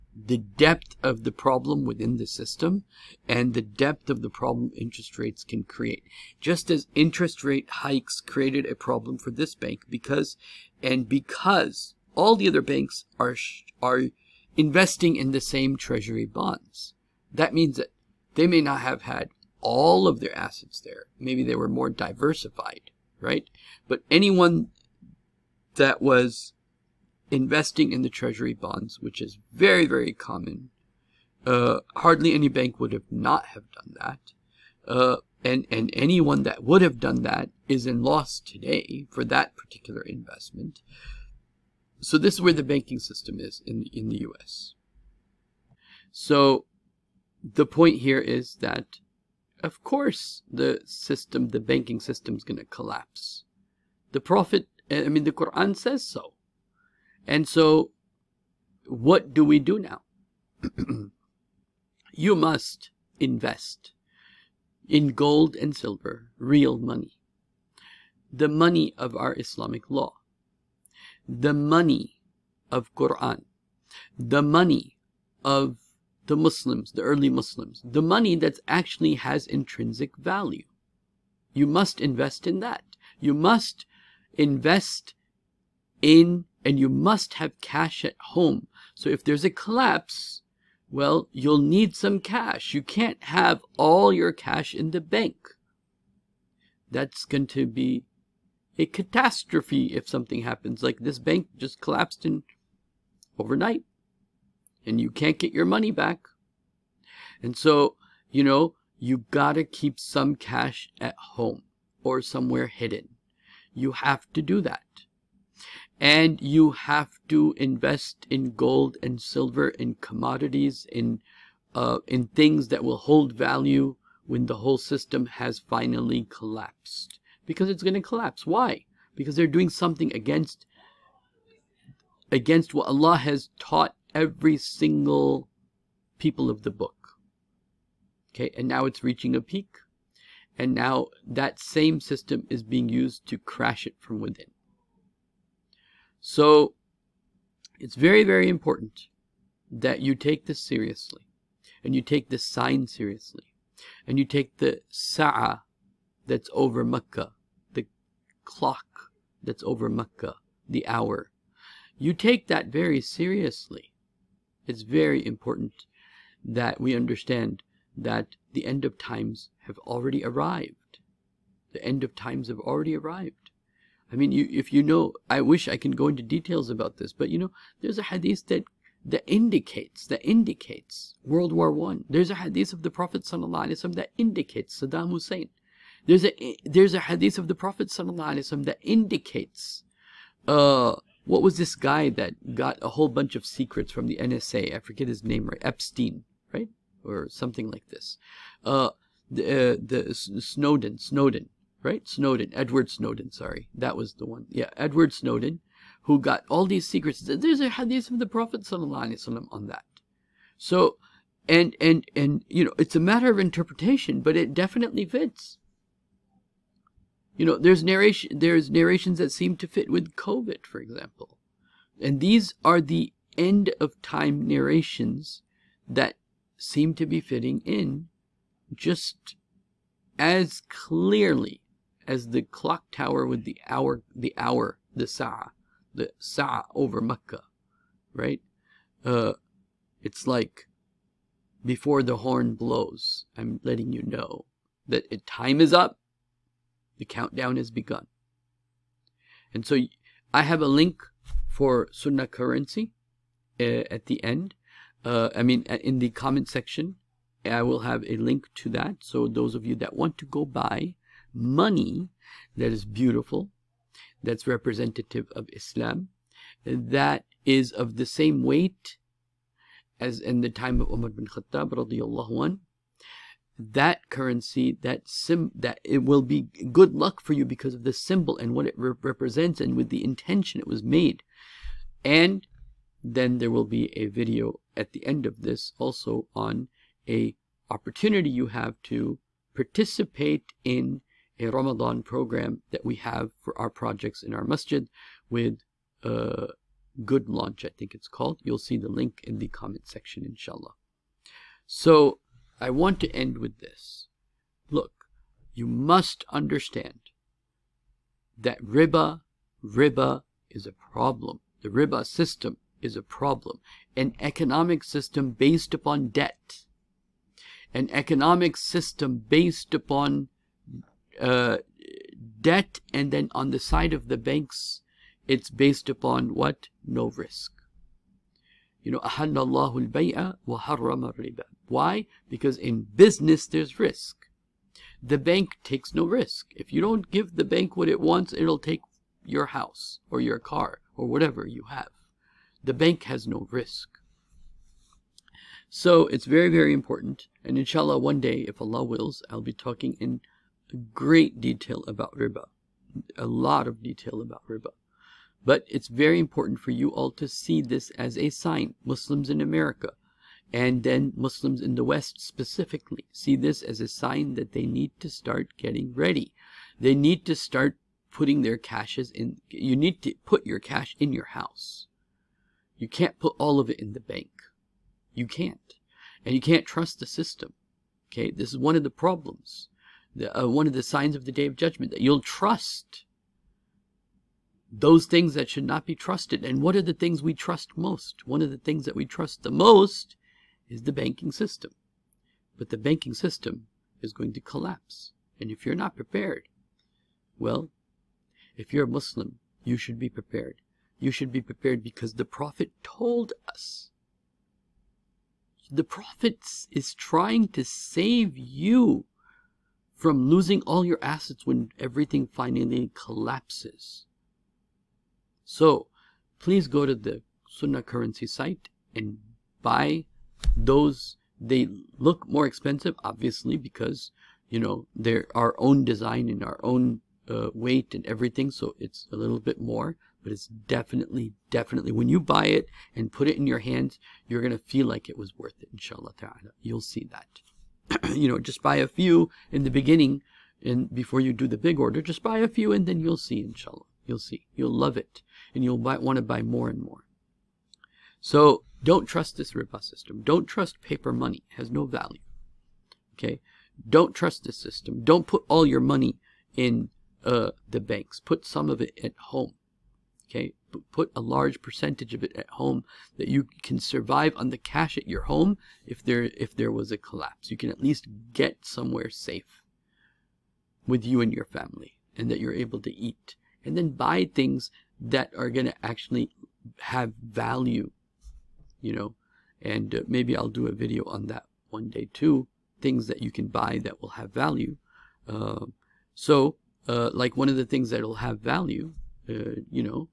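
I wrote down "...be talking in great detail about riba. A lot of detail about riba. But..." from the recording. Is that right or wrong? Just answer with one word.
right.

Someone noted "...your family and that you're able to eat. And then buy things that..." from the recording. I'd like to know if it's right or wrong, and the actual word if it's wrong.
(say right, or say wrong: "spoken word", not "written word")
right.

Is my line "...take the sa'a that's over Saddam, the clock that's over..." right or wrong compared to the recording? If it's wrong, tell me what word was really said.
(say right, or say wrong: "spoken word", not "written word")
wrong: "Mecca", not "Saddam".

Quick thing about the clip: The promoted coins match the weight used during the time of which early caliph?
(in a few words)
Umar bin Khattab.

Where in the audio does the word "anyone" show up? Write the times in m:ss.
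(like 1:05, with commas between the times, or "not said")
0:24, 0:35.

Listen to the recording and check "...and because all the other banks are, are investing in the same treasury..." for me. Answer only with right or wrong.
right.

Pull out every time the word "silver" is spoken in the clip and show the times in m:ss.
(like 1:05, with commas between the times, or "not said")
1:05, 1:59.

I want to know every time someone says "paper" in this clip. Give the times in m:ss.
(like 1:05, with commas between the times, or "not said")
7:30.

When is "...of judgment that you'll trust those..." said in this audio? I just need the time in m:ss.
6:21.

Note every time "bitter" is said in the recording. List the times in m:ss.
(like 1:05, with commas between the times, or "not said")
not said.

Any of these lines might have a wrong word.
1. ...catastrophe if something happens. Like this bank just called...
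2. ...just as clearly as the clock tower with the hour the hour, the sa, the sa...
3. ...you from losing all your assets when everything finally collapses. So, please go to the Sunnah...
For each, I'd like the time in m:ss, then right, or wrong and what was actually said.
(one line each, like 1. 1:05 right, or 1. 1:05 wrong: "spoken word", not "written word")
1. 1:38 wrong: "collapsed", not "called"
2. 3:48 right
3. 6:48 right.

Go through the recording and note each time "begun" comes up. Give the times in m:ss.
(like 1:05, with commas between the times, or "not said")
4:07.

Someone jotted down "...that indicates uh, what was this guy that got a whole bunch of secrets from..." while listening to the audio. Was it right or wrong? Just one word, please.
right.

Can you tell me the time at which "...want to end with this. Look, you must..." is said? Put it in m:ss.
5:02.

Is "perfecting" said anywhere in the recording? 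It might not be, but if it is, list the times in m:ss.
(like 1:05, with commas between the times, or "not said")
not said.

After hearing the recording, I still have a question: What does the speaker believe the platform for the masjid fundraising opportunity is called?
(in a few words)
Good Launch.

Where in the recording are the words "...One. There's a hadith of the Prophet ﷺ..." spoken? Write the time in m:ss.
3:01.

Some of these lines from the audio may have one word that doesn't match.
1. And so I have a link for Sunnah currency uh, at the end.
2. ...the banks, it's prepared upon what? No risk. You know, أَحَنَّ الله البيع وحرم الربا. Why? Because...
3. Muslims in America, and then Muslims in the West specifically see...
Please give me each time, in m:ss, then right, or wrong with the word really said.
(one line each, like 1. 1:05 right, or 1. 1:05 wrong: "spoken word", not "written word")
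1. 4:09 right
2. 5:24 wrong: "based", not "prepared"
3. 5:58 right.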